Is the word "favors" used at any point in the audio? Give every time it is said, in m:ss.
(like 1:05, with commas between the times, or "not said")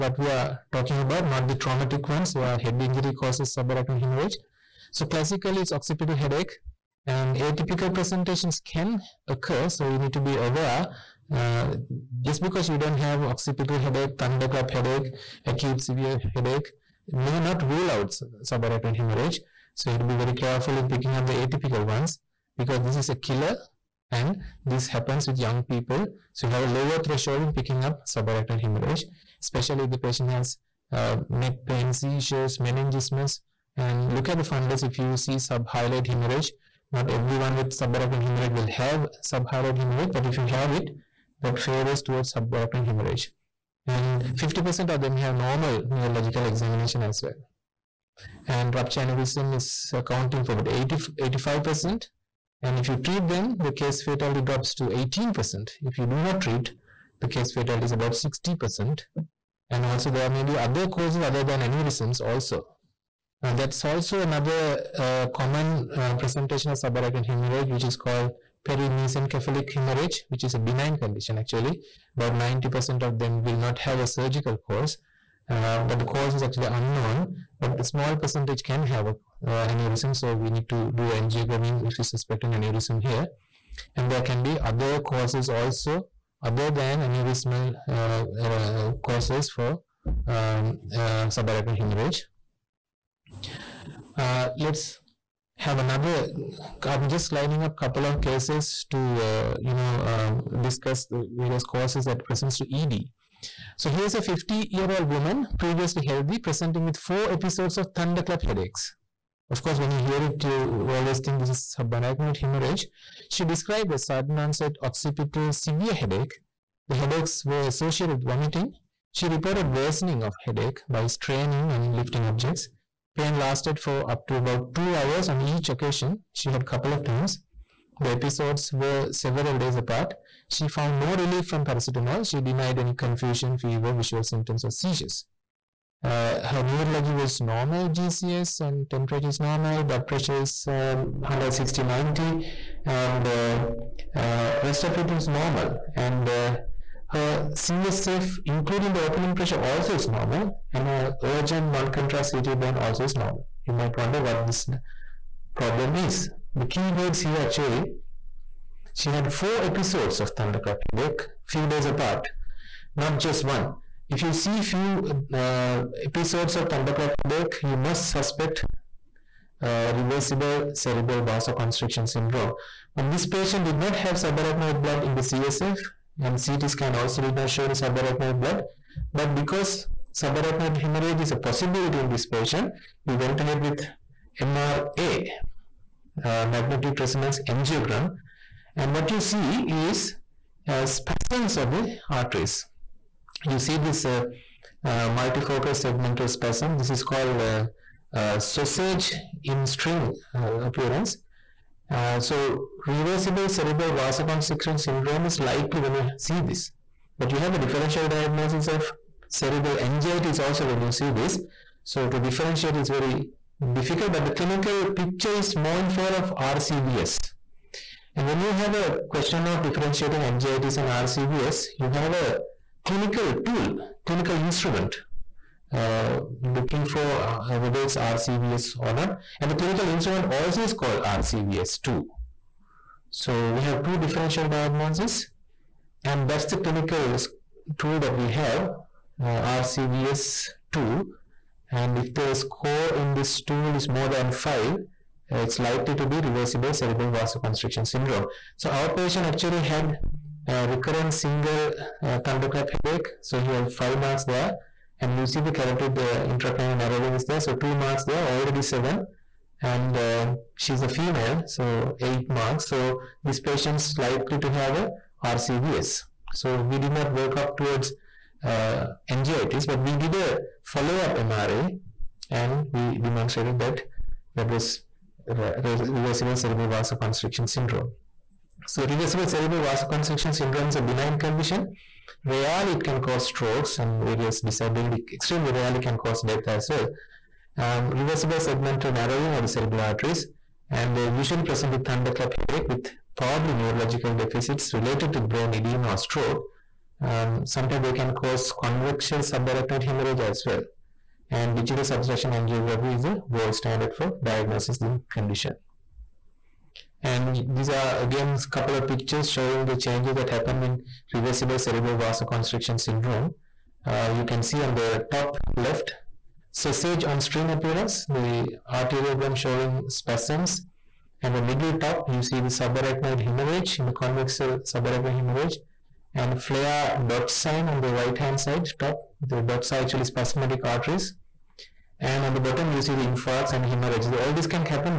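0:41, 3:35.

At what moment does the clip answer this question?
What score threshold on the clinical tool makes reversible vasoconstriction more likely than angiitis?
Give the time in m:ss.
4:03.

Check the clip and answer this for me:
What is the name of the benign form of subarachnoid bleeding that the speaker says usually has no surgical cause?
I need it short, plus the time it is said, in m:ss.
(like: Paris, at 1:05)
perimesencephalic hemorrhage, at 1:08.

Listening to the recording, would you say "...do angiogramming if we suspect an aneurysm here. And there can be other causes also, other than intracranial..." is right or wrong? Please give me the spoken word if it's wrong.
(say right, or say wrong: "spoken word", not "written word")
wrong: "aneurysmal", not "intracranial".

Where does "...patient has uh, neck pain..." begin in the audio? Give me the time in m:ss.
0:29.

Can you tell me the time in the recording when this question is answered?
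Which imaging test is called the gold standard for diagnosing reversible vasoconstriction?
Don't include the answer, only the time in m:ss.
5:01.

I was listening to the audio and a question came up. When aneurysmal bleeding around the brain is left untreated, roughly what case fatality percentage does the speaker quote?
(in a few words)
60%.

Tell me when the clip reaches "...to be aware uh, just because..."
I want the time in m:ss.
0:10.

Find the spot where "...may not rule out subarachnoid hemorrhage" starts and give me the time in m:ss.
0:17.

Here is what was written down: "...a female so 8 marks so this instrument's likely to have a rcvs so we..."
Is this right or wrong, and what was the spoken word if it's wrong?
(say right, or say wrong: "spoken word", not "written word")
wrong: "patient", not "instrument".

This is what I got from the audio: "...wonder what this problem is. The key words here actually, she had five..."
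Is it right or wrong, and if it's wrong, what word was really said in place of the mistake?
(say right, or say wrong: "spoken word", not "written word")
wrong: "four", not "five".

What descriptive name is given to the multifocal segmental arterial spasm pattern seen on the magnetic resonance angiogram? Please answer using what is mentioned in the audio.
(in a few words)
sausage in string appearance.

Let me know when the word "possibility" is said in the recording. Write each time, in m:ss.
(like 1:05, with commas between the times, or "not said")
3:01.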